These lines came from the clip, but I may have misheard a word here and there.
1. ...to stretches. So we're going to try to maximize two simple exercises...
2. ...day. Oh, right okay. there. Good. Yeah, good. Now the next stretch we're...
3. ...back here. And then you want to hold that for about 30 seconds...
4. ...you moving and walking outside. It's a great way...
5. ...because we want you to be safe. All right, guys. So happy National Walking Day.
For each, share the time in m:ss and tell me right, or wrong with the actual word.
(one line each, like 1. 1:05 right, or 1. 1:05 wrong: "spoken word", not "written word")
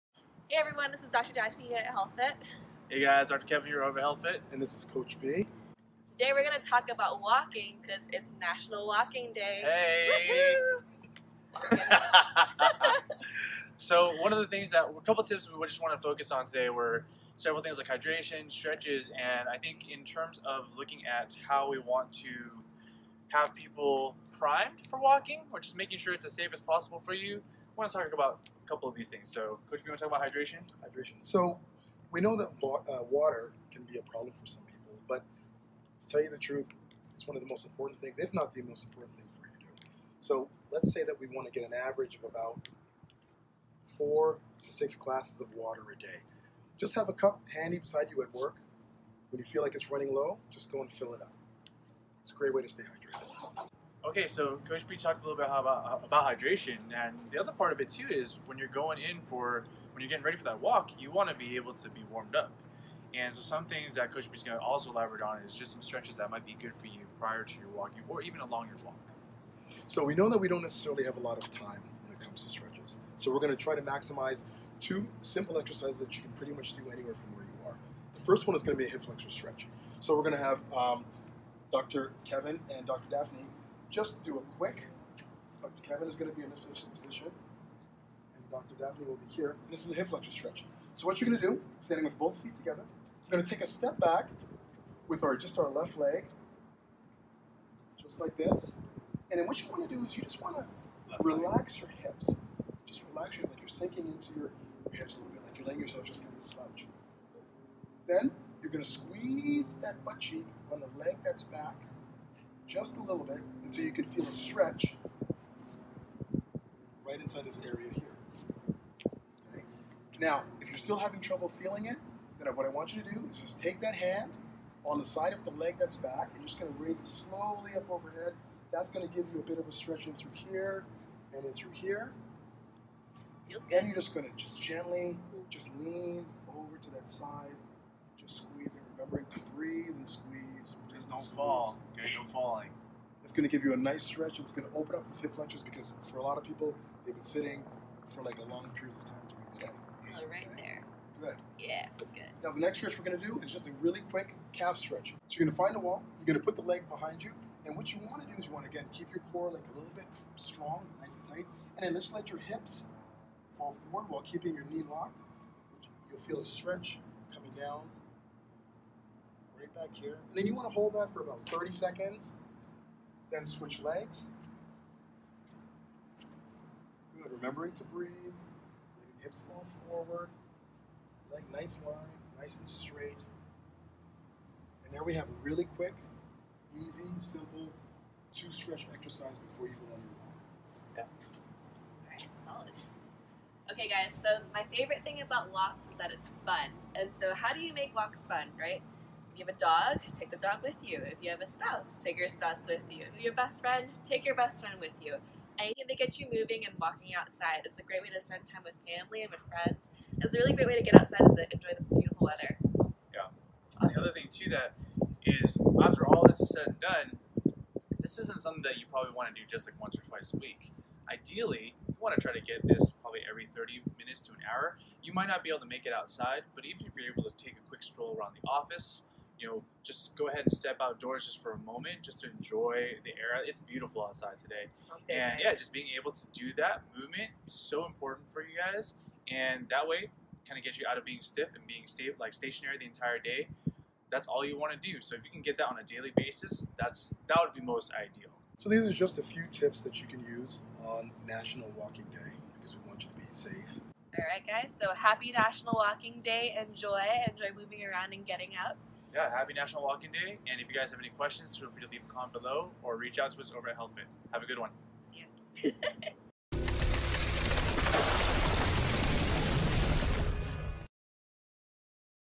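1. 1:12 right
2. 2:29 right
3. 2:49 right
4. 3:26 right
5. 4:12 right.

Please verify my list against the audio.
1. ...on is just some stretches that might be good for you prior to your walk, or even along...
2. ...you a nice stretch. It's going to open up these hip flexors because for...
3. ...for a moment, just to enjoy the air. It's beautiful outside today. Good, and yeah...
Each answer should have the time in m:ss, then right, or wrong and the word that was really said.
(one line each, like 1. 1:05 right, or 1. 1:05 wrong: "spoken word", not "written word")
1. 1:05 right
2. 2:23 right
3. 3:51 right.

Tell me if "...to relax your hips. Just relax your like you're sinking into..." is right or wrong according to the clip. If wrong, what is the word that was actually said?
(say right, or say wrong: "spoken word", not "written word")
right.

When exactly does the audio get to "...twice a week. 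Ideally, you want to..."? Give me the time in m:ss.
3:40.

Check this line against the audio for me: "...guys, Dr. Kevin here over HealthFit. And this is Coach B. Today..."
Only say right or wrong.
right.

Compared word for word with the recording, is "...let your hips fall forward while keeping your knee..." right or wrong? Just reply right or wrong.
right.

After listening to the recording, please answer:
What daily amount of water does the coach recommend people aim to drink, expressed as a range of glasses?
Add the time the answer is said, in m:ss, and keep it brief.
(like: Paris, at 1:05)
4 to 6 glasses, at 0:43.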